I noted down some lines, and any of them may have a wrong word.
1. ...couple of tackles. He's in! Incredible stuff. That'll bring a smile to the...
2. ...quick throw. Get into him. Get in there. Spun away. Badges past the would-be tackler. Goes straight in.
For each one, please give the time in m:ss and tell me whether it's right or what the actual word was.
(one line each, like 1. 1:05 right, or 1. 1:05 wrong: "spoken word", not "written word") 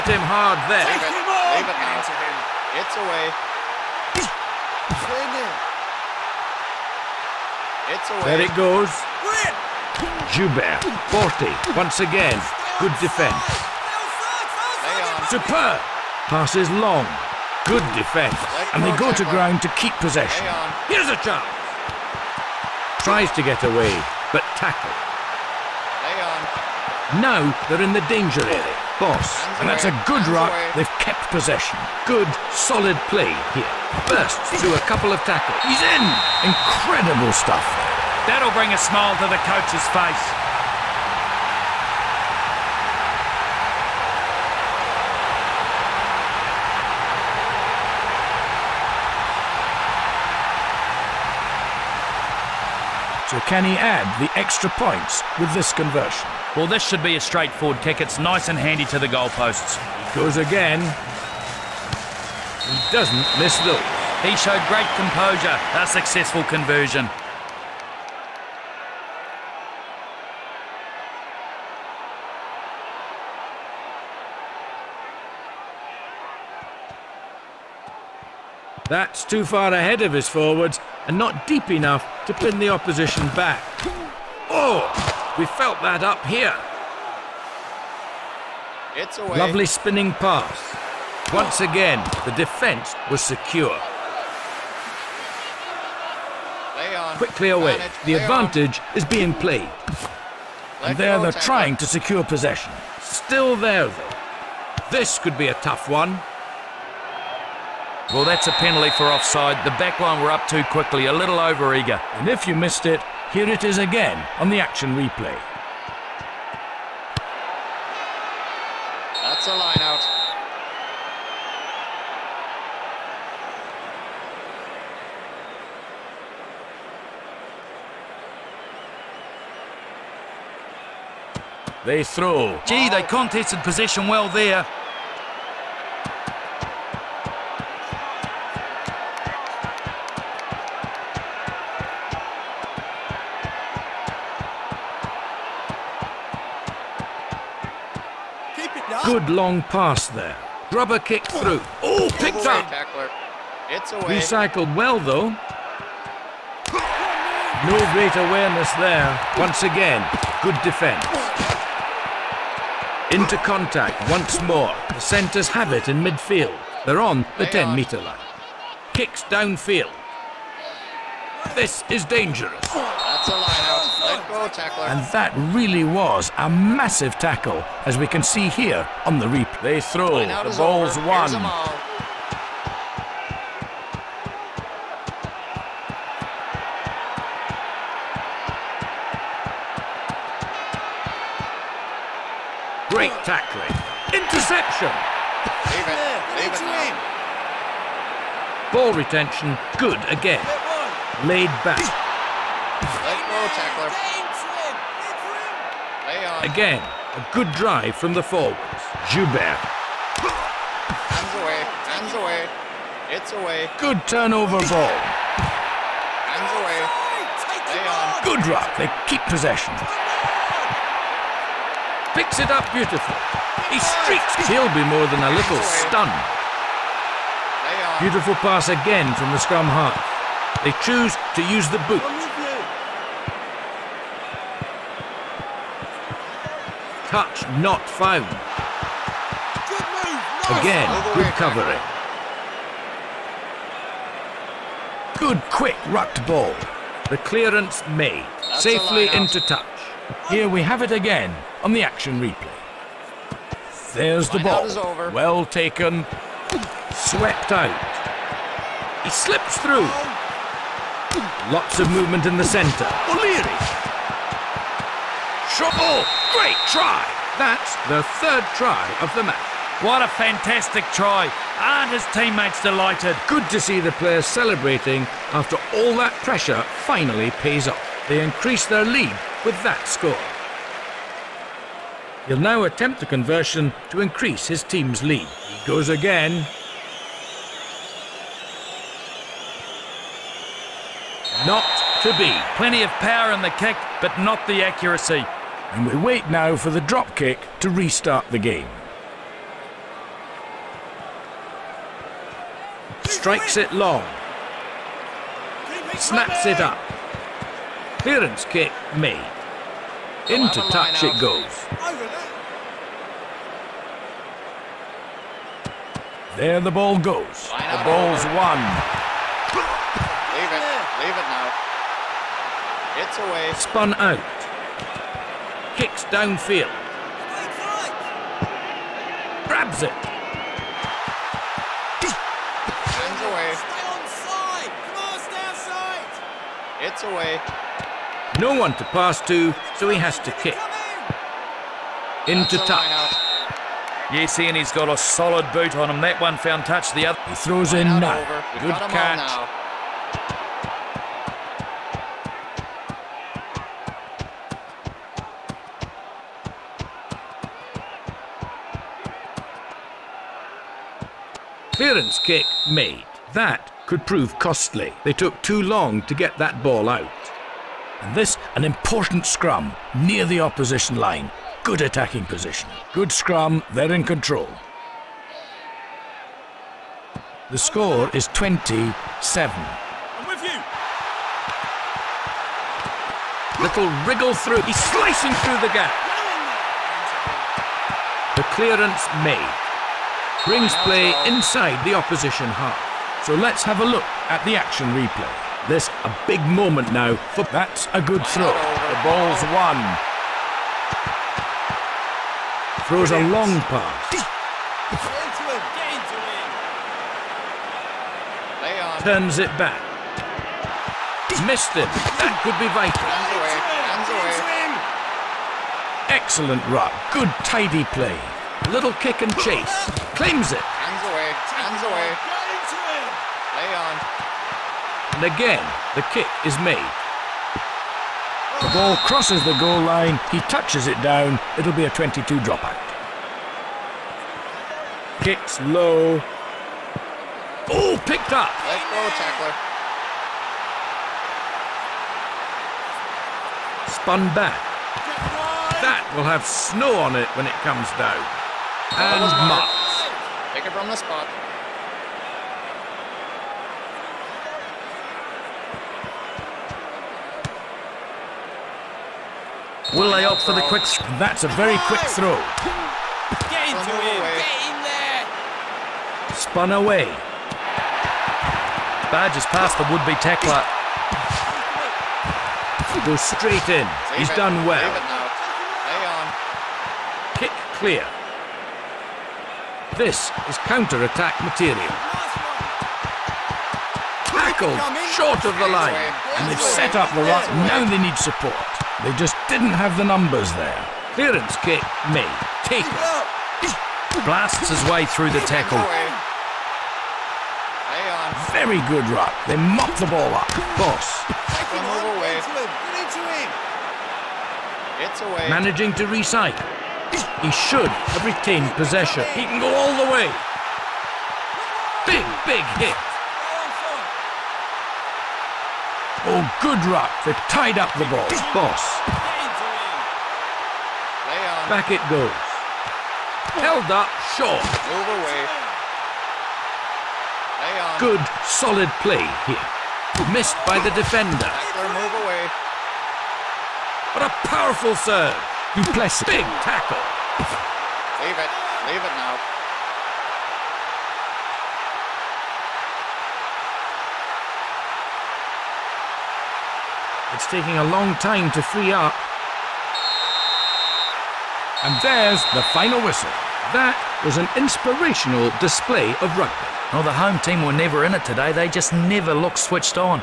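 1. 0:34 right
2. 7:41 right.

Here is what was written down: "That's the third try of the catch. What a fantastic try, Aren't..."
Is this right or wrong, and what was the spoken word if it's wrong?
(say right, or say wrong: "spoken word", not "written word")
wrong: "match", not "catch".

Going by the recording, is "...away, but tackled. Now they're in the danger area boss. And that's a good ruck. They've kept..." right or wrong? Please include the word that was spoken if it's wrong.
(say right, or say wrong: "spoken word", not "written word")
right.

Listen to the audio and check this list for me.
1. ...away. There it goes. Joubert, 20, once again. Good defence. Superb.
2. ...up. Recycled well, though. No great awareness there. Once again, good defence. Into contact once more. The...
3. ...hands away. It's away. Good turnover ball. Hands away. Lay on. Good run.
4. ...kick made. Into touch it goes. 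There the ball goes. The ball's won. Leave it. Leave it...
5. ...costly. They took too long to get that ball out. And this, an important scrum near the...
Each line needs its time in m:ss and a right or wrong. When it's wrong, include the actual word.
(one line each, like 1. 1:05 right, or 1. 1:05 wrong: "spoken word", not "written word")
1. 0:08 wrong: "40", not "20"
2. 2:32 right
3. 3:31 right
4. 5:08 right
5. 6:04 right.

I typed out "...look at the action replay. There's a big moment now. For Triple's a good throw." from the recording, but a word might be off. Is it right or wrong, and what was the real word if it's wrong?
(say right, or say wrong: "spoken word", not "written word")
wrong: "That", not "Triple".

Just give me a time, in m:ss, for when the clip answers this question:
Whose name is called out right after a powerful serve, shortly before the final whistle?
8:55.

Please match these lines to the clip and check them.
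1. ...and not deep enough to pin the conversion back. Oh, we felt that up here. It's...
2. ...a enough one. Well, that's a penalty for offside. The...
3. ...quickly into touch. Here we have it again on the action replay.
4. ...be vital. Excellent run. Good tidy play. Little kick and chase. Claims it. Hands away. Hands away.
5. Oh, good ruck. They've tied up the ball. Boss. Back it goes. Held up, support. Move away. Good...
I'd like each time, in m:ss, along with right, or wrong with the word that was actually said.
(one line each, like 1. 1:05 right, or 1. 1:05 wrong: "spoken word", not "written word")
1. 1:21 wrong: "opposition", not "conversion"
2. 1:45 wrong: "tough", not "enough"
3. 4:08 wrong: "safely", not "quickly"
4. 6:52 right
5. 8:36 wrong: "short", not "support".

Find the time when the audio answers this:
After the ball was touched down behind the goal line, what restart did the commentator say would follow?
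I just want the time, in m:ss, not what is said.
7:11.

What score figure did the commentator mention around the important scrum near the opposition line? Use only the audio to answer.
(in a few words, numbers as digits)
27.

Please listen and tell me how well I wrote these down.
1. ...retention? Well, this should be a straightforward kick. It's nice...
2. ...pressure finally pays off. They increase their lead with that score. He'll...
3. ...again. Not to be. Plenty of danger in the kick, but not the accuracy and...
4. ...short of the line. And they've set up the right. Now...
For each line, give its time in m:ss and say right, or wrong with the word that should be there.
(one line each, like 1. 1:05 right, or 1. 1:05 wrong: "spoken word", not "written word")
1. 0:55 wrong: "conversion", not "retention"
2. 4:36 right
3. 4:45 wrong: "power", not "danger"
4. 8:05 right.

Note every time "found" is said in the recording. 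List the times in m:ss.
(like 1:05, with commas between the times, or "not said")
3:57, 5:46.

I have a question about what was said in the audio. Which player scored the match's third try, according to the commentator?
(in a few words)
O'Leary.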